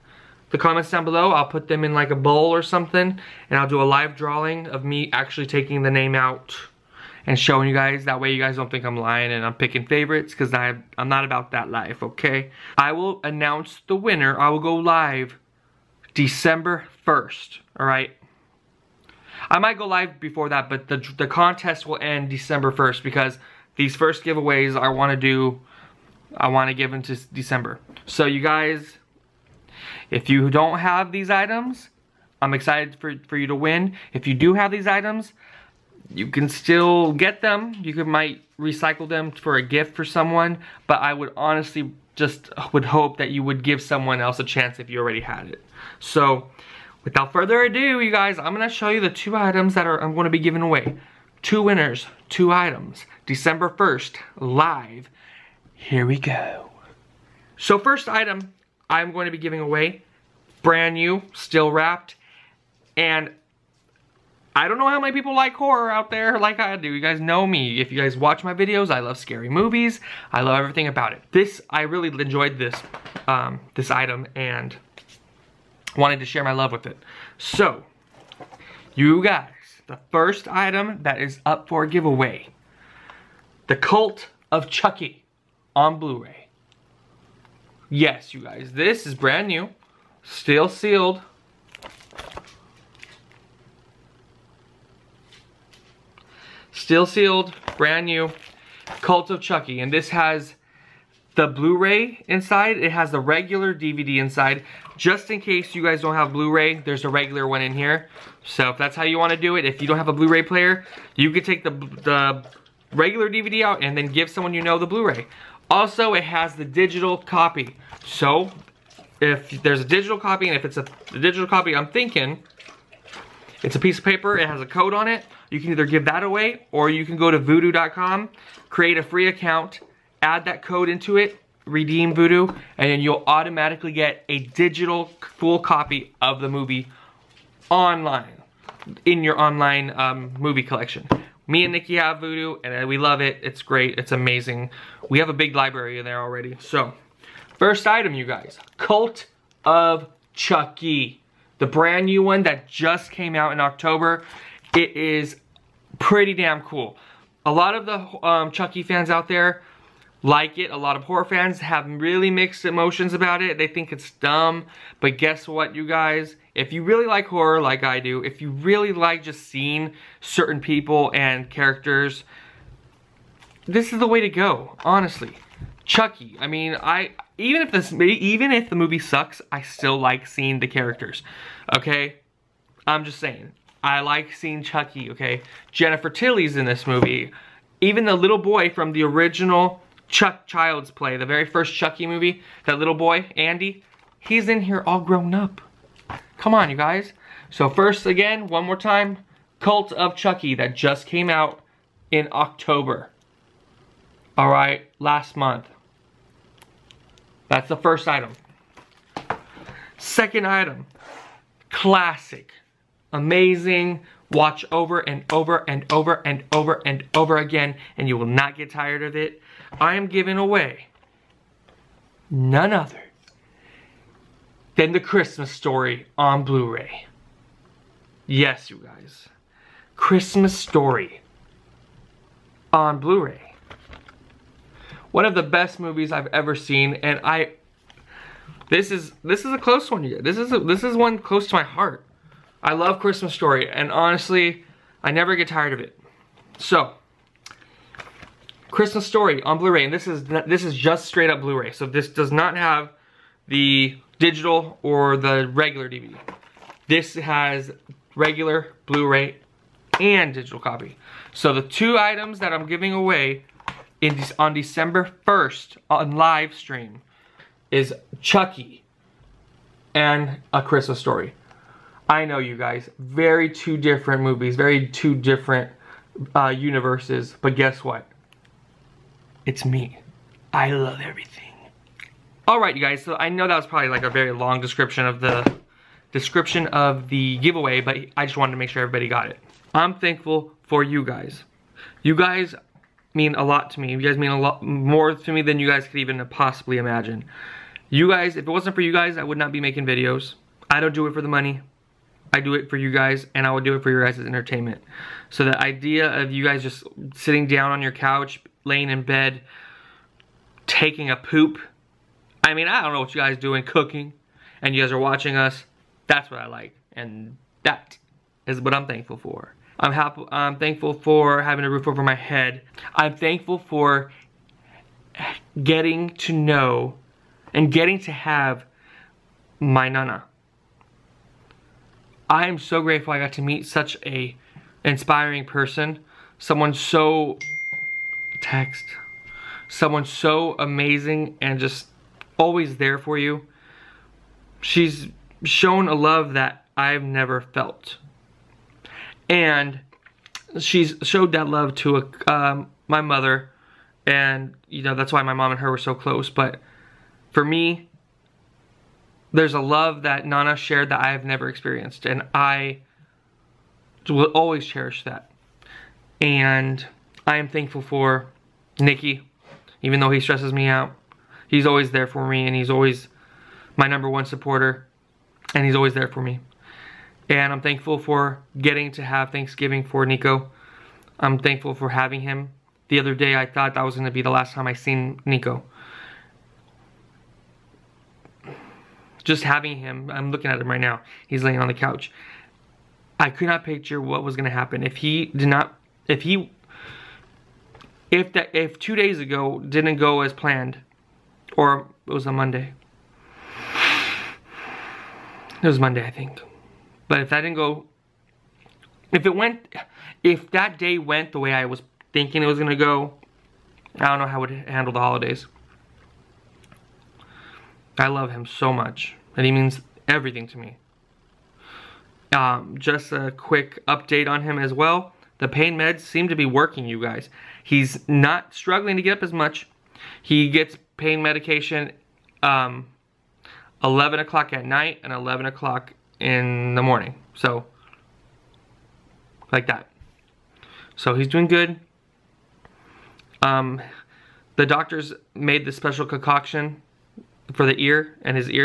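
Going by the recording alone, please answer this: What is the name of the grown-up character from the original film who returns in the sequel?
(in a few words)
Andy.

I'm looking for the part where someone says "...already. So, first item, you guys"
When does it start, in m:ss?
2:26.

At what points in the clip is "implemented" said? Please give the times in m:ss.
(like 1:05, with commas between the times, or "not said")
not said.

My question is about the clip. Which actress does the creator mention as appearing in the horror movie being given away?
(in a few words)
Jennifer Tilly.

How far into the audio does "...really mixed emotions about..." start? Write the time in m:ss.
2:41.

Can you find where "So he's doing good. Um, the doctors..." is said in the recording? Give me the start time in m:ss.
7:20.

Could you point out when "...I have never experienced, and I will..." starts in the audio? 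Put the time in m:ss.
6:01.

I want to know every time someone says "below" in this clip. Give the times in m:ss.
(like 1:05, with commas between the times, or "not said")
0:01.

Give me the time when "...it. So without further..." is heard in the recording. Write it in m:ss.
0:45.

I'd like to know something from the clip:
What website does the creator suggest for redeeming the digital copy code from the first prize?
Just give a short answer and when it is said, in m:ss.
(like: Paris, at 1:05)
vudu.com, at 2:07.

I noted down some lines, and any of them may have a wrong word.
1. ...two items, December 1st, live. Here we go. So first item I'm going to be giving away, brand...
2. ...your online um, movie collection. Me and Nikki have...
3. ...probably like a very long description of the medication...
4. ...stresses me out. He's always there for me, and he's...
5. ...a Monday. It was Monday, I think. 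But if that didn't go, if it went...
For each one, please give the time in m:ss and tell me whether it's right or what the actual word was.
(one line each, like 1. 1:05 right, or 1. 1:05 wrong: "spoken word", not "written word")
1. 0:52 right
2. 2:19 right
3. 4:43 wrong: "description", not "medication"
4. 6:10 right
5. 6:42 right.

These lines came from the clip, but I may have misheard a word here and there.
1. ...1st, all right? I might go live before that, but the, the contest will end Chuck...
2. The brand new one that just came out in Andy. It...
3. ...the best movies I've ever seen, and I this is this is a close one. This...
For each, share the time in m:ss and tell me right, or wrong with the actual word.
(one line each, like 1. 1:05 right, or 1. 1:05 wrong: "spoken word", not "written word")
1. 0:17 wrong: "December", not "Chuck"
2. 2:31 wrong: "October", not "Andy"
3. 3:55 right.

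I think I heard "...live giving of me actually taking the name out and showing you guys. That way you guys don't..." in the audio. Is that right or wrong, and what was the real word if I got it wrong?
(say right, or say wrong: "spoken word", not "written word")
wrong: "drawing", not "giving".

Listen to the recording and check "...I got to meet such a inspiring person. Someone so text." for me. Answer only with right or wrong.
right.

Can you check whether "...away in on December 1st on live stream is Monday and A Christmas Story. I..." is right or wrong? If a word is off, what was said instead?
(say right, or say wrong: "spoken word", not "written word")
wrong: "Chucky", not "Monday".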